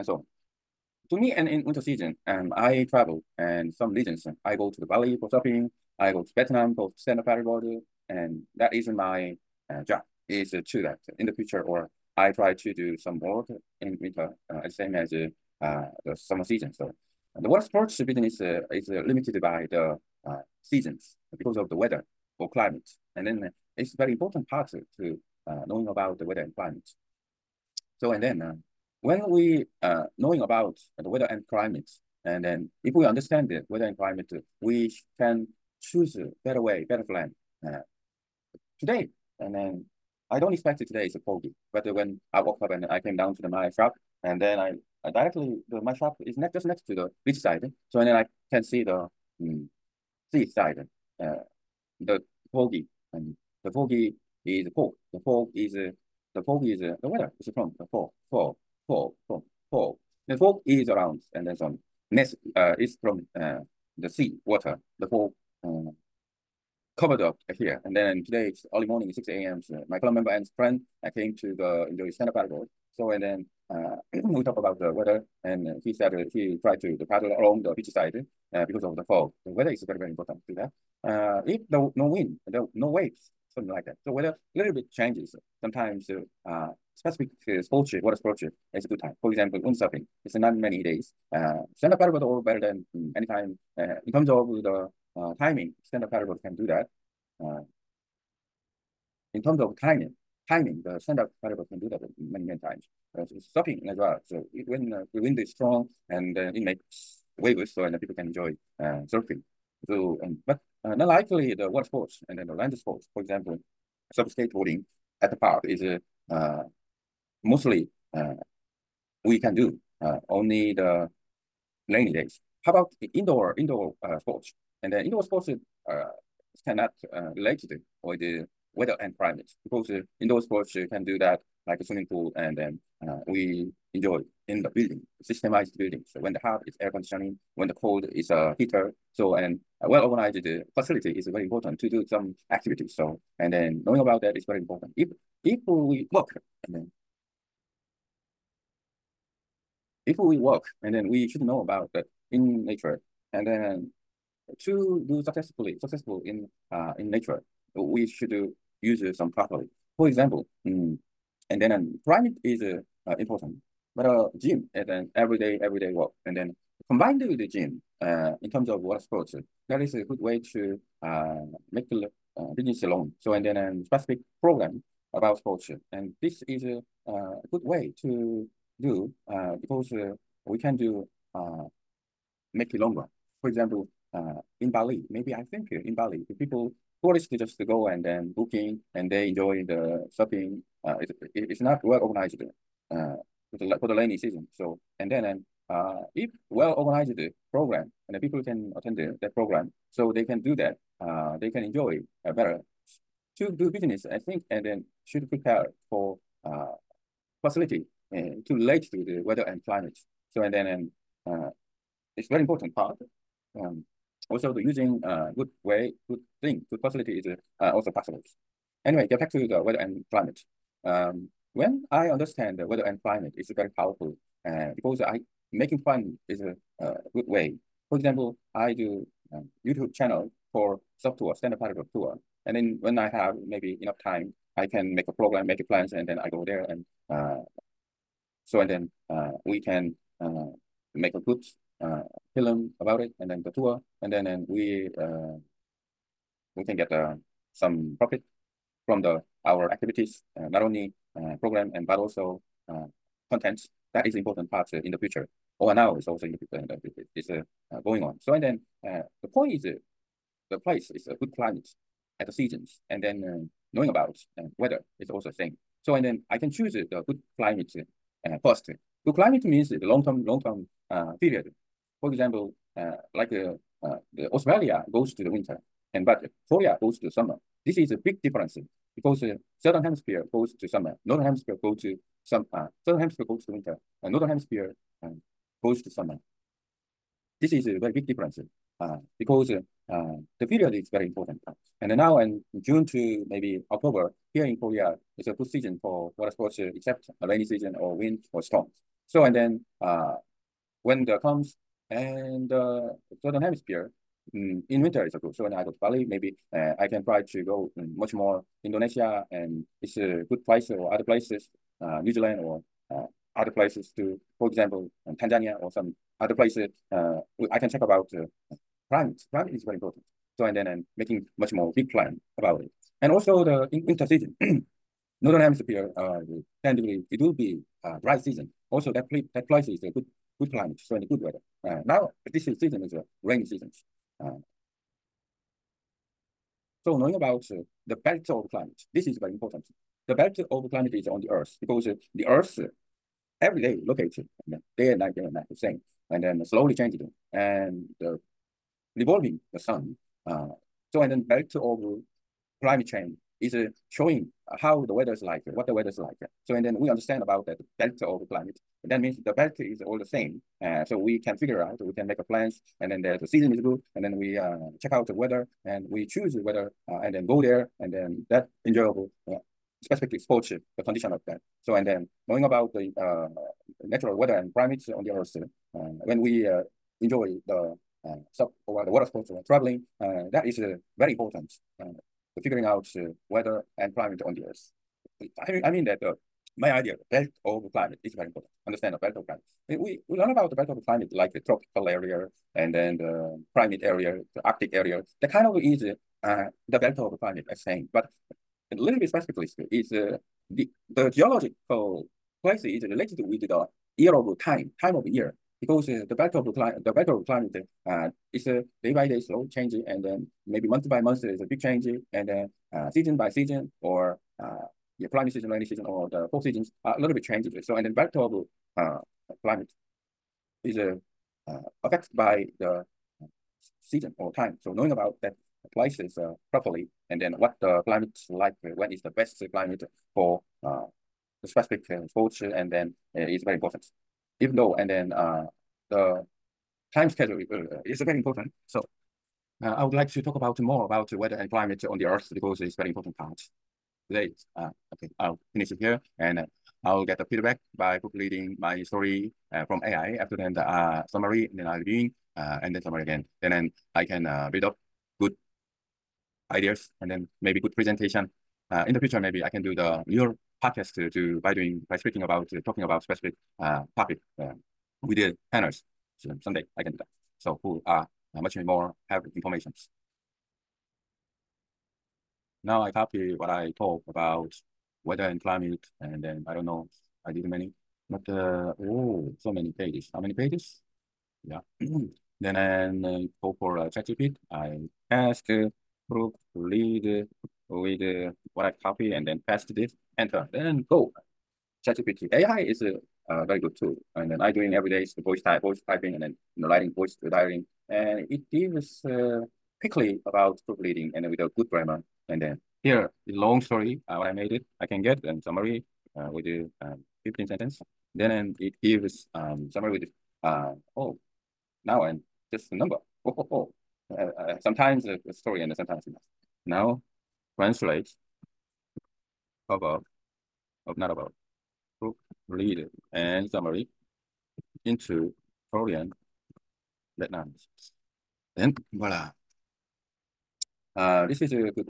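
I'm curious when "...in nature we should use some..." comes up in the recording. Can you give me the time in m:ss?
2:36.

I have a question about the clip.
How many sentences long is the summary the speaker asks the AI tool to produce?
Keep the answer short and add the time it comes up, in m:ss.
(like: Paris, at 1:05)
15, at 8:27.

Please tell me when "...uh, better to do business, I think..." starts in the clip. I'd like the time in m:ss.
3:22.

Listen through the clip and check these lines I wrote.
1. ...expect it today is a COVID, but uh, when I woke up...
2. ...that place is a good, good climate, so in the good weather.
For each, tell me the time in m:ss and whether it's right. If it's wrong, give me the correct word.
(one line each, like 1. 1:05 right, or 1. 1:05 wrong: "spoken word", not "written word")
1. 0:40 right
2. 5:29 right.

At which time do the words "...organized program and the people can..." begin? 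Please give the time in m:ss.
3:16.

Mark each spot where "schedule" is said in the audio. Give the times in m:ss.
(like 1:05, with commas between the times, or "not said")
7:17.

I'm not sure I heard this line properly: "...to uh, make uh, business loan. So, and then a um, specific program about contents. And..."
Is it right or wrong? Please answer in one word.
wrong.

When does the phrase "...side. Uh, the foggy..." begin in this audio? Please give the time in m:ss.
0:50.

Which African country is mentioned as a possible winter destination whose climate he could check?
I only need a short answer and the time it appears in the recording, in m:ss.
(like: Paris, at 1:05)
Tanzania, at 5:15.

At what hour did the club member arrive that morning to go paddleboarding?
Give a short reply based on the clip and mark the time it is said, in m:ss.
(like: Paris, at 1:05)
6 a.m., at 1:09.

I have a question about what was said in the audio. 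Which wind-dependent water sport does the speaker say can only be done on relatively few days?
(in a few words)
Windsurfing.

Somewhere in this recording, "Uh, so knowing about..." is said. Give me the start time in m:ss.
5:34.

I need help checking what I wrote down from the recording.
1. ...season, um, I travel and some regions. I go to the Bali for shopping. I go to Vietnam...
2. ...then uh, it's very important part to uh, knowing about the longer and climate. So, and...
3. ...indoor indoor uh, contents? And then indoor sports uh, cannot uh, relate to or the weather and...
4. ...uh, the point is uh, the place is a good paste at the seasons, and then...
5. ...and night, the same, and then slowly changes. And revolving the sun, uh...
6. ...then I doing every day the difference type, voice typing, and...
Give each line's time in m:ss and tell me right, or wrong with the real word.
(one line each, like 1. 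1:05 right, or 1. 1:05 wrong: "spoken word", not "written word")
1. 0:01 right
2. 0:23 wrong: "weather", not "longer"
3. 2:03 wrong: "sports", not "contents"
4. 4:18 wrong: "climate", not "paste"
5. 5:45 right
6. 8:14 wrong: "voice", not "difference".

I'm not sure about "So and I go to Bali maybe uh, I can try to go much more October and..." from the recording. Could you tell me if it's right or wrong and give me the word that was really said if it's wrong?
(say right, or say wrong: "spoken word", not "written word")
wrong: "Indonesia", not "October".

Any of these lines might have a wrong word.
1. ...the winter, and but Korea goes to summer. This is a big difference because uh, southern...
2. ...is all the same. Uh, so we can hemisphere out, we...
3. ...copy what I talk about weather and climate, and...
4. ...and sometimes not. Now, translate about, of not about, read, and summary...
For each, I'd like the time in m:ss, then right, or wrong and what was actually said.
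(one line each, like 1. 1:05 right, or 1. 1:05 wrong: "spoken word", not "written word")
1. 4:35 right
2. 5:59 wrong: "figure", not "hemisphere"
3. 7:52 right
4. 8:35 right.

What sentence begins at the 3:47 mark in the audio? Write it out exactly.
For example, I do um, YouTube channel for soft tour, stand-up paddleboard tour.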